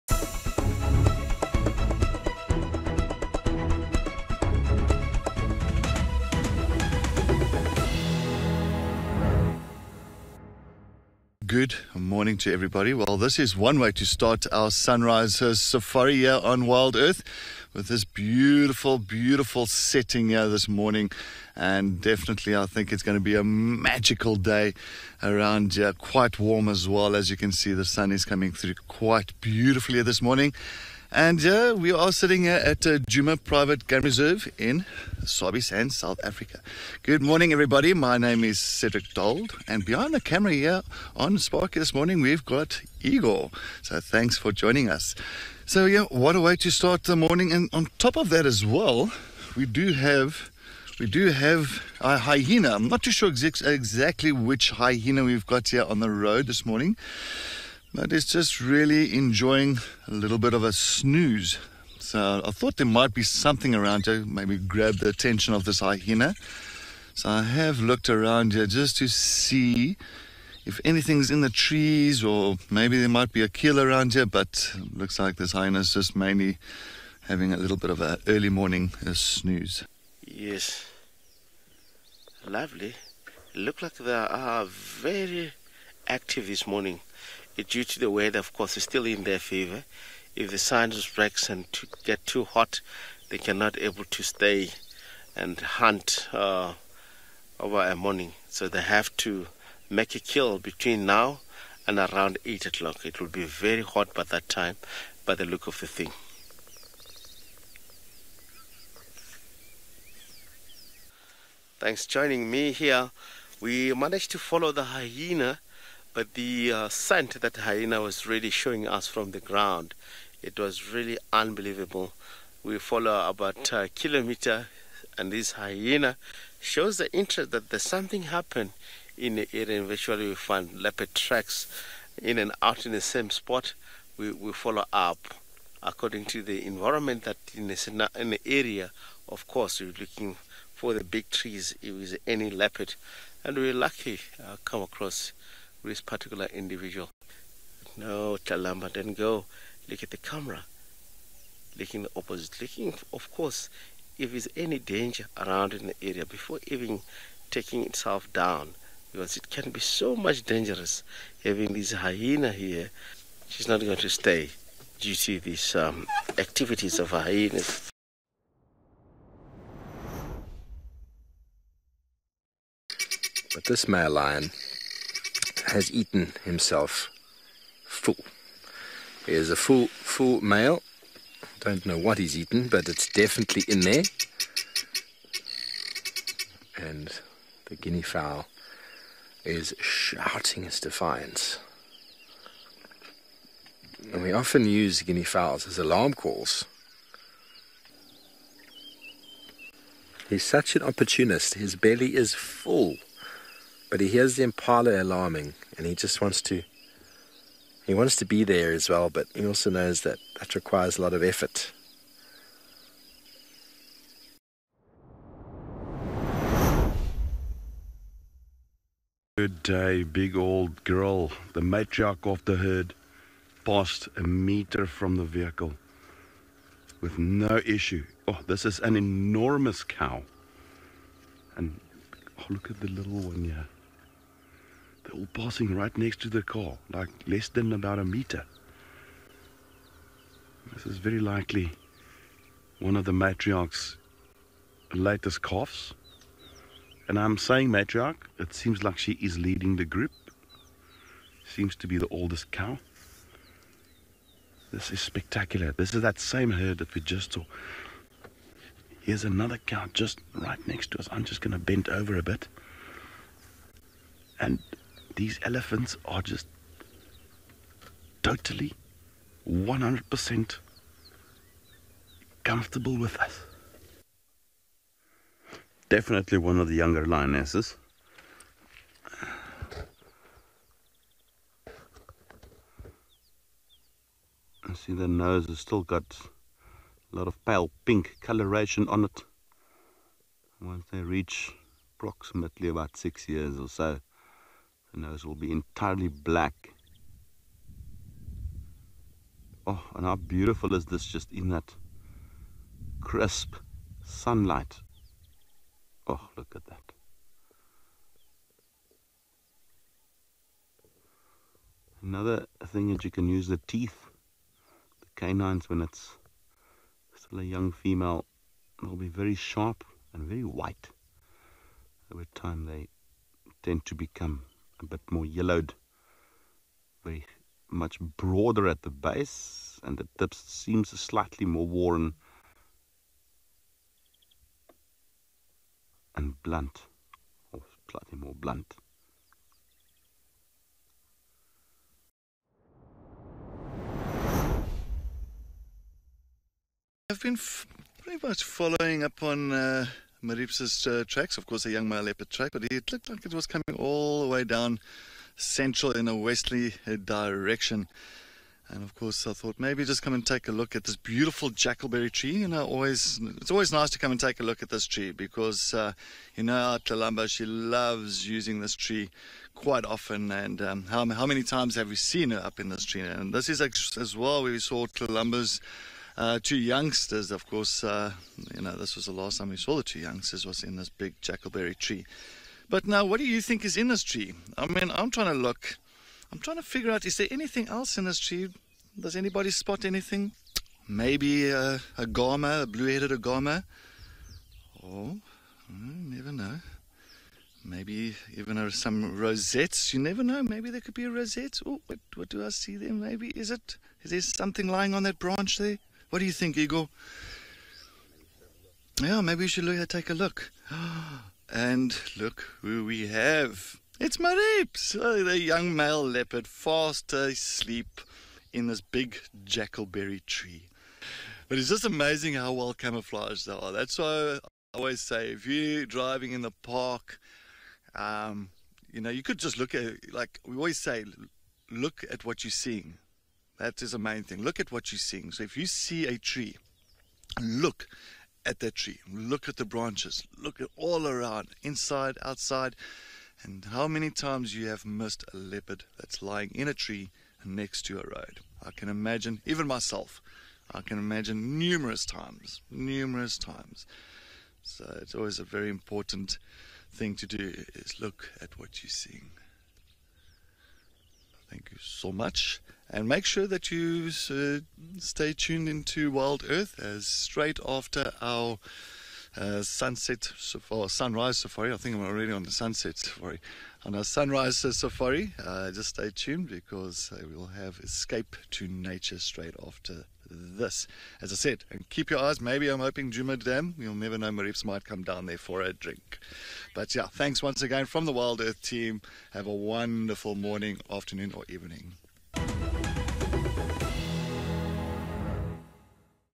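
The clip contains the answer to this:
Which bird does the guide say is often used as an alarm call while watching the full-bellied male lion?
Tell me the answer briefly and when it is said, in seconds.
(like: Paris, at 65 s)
Guinea fowl, at 195 s.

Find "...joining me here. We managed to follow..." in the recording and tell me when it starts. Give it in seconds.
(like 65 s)
112 s.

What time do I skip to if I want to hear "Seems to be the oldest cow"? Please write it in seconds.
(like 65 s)
251 s.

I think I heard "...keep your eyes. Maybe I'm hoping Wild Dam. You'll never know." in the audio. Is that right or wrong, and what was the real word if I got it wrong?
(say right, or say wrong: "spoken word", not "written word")
wrong: "Djuma", not "Wild".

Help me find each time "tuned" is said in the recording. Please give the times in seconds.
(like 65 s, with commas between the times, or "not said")
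465 s, 476 s.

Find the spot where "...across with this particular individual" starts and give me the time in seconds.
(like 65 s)
144 s.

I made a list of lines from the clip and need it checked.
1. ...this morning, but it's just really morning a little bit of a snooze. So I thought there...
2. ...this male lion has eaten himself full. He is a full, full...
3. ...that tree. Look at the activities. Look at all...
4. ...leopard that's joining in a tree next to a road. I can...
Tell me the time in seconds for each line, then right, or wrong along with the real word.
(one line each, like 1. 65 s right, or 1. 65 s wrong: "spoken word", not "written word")
1. 56 s wrong: "enjoying", not "morning"
2. 173 s right
3. 438 s wrong: "branches", not "activities"
4. 445 s wrong: "lying", not "joining".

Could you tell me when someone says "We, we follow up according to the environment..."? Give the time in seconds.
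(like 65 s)
134 s.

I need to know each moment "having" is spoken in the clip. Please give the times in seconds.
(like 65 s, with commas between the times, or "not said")
77 s, 161 s.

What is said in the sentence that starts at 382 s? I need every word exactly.
But now, what do you think is in this tree?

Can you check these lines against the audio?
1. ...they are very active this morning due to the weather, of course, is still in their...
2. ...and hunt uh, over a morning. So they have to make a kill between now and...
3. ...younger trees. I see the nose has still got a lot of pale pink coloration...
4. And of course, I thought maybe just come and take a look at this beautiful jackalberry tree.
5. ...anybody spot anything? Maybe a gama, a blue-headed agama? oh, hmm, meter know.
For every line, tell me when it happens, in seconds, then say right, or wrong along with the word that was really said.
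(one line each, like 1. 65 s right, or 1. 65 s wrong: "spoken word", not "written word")
1. 83 s right
2. 95 s right
3. 276 s wrong: "lionesses", not "trees"
4. 358 s right
5. 389 s wrong: "never", not "meter".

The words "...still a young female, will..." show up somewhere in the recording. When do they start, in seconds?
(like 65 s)
317 s.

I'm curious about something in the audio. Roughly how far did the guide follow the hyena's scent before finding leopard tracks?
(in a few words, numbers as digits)
1 kilometer.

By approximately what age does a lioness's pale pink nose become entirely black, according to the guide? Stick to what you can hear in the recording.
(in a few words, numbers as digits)
About 6 years.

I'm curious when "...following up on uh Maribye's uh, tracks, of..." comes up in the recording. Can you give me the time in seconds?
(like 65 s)
348 s.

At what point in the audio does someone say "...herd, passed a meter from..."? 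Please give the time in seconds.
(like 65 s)
222 s.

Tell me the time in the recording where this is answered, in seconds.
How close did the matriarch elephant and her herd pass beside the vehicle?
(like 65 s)
237 s.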